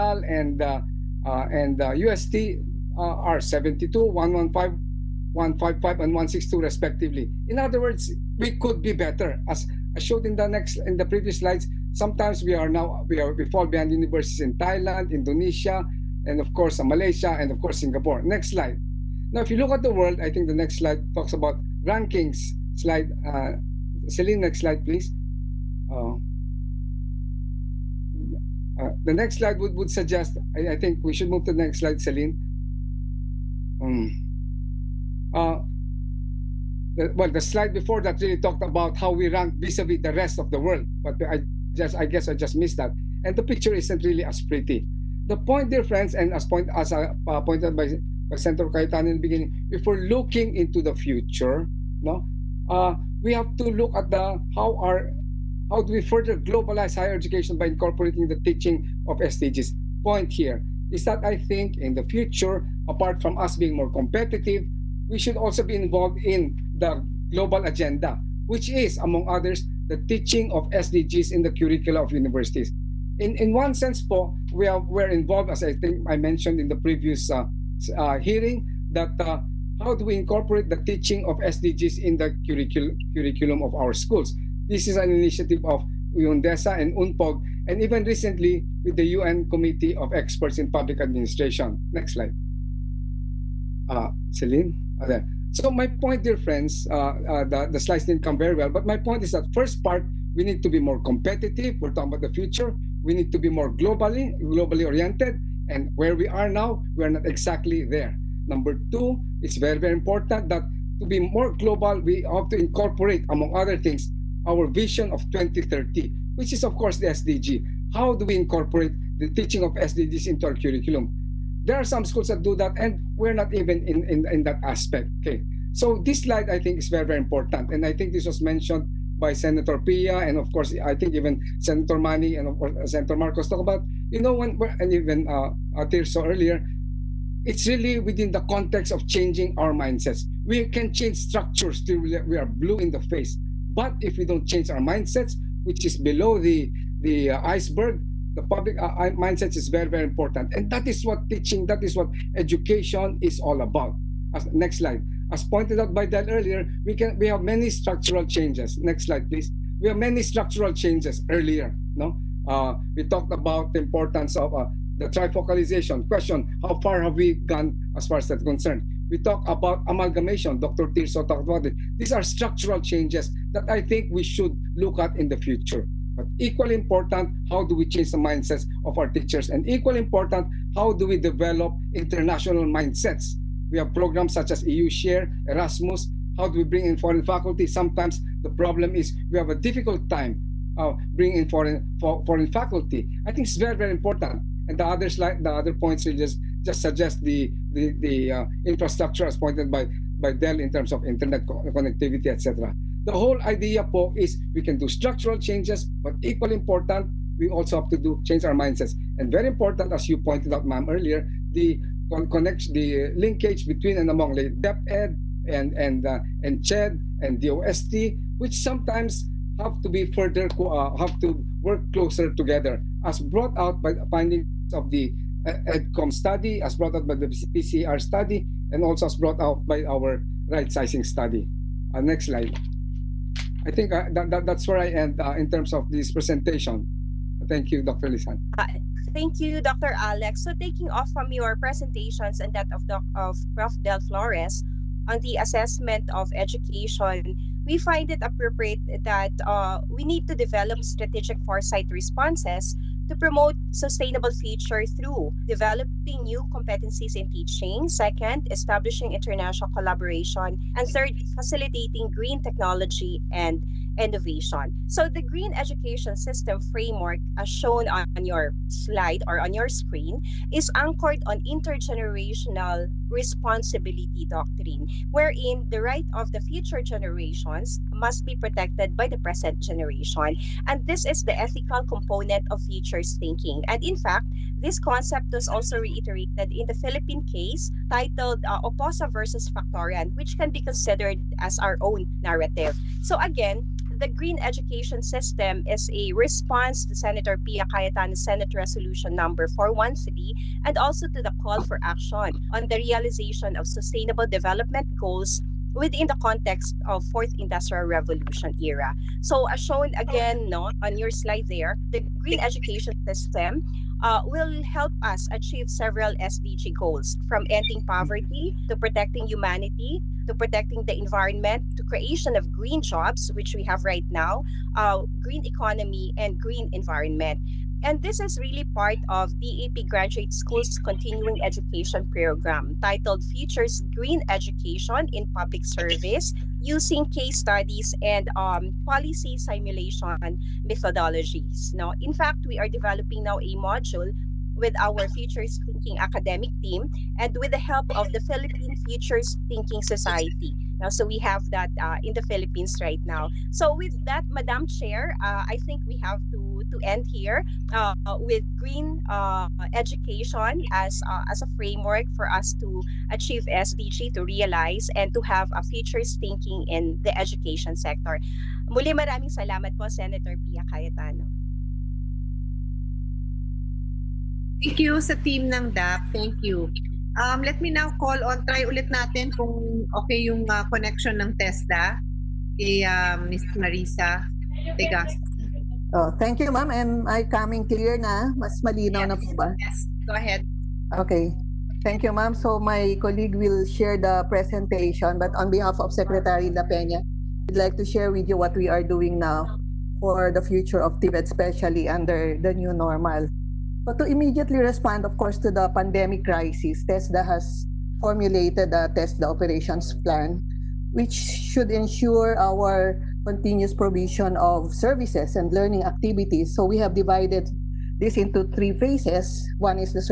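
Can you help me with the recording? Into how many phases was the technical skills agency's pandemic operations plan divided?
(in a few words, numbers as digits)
3.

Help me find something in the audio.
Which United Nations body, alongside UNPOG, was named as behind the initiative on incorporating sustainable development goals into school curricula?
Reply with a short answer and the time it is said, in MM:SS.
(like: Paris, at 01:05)
UNDESA, at 01:26.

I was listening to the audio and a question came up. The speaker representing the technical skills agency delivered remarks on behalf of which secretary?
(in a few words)
Secretary La Peña.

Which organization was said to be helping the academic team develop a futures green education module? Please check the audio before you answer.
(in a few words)
Philippine Futures Thinking Society.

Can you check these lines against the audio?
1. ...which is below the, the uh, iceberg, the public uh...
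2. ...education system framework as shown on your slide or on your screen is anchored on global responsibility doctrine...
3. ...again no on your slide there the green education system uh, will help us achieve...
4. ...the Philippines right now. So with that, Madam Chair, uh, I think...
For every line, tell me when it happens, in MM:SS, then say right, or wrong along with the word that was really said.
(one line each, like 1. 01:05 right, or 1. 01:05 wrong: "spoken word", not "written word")
1. 02:25 right
2. 04:25 wrong: "intergenerational", not "global"
3. 05:10 right
4. 05:52 right.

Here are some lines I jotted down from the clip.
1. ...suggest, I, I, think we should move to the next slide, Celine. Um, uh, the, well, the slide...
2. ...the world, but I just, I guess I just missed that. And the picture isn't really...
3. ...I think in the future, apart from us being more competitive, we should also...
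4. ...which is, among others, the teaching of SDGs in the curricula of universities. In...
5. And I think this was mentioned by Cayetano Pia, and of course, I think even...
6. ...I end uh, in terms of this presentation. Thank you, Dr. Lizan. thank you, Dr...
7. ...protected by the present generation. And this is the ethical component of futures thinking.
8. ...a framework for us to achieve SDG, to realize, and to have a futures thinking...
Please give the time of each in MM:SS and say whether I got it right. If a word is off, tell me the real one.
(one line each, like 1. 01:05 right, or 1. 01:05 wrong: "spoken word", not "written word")
1. 00:29 right
2. 00:40 right
3. 01:01 right
4. 01:08 right
5. 02:07 wrong: "Senator", not "Cayetano"
6. 03:54 right
7. 04:38 right
8. 06:01 right.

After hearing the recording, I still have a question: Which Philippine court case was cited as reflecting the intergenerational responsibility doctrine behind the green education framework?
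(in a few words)
Oposa versus Factoran.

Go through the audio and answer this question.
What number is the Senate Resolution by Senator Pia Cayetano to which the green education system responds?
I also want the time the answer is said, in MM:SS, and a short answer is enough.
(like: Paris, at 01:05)
413, at 04:59.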